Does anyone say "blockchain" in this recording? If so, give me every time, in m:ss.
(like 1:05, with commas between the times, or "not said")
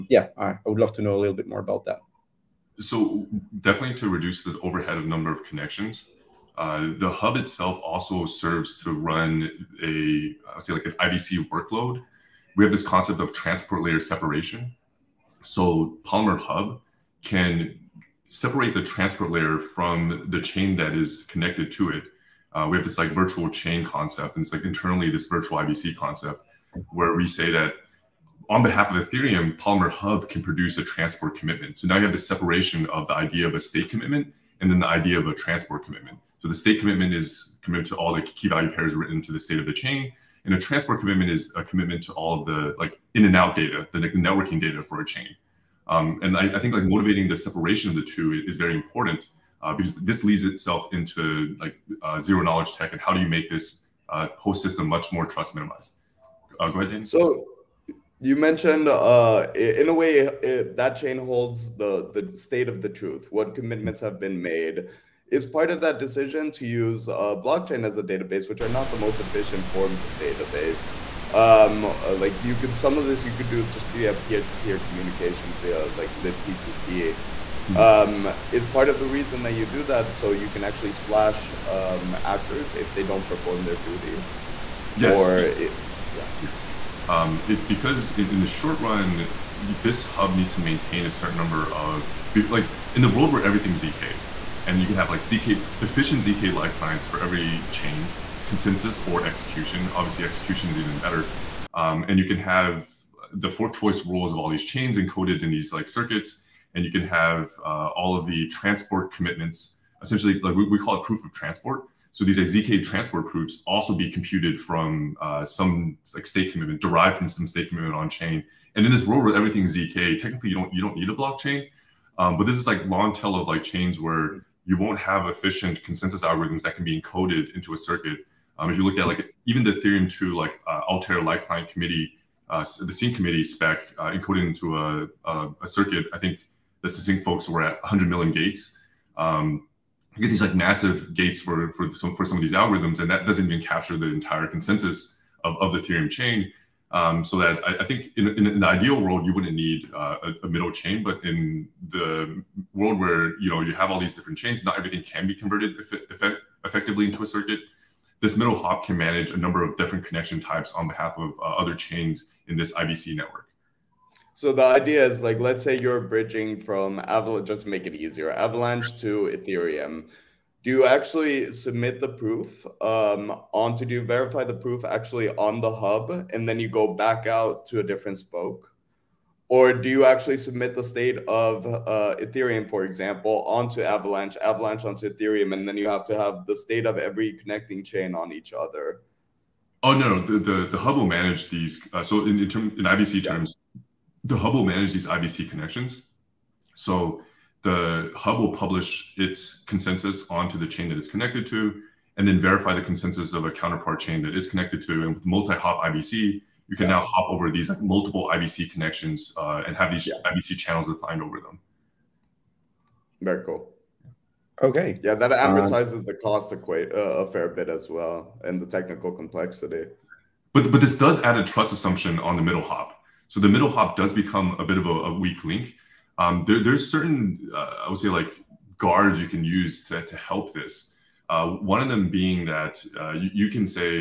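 1:07, 2:01.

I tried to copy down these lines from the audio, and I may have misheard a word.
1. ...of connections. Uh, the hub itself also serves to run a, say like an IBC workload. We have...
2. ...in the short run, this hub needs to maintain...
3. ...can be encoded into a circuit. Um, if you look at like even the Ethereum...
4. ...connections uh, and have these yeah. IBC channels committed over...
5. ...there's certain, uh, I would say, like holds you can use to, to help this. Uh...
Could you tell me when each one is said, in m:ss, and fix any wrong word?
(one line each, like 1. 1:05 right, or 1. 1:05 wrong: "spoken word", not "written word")
1. 0:05 right
2. 1:28 right
3. 2:06 right
4. 3:28 wrong: "defined", not "committed"
5. 3:46 wrong: "guards", not "holds".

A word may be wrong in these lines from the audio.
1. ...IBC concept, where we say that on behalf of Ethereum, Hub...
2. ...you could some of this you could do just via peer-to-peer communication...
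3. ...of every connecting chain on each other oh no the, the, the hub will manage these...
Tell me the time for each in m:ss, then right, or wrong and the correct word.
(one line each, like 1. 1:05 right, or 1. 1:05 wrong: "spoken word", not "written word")
1. 0:25 wrong: "Polymer", not "Hub"
2. 1:12 right
3. 3:06 right.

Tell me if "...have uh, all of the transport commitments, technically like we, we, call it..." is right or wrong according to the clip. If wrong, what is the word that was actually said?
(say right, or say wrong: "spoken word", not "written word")
wrong: "essentially", not "technically".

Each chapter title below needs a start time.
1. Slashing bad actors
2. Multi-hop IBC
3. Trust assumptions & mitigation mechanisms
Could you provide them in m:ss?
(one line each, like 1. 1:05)
1. 1:01
2. 3:11
3. 3:36.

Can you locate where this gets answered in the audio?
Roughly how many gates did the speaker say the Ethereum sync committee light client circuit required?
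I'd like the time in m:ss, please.
2:17.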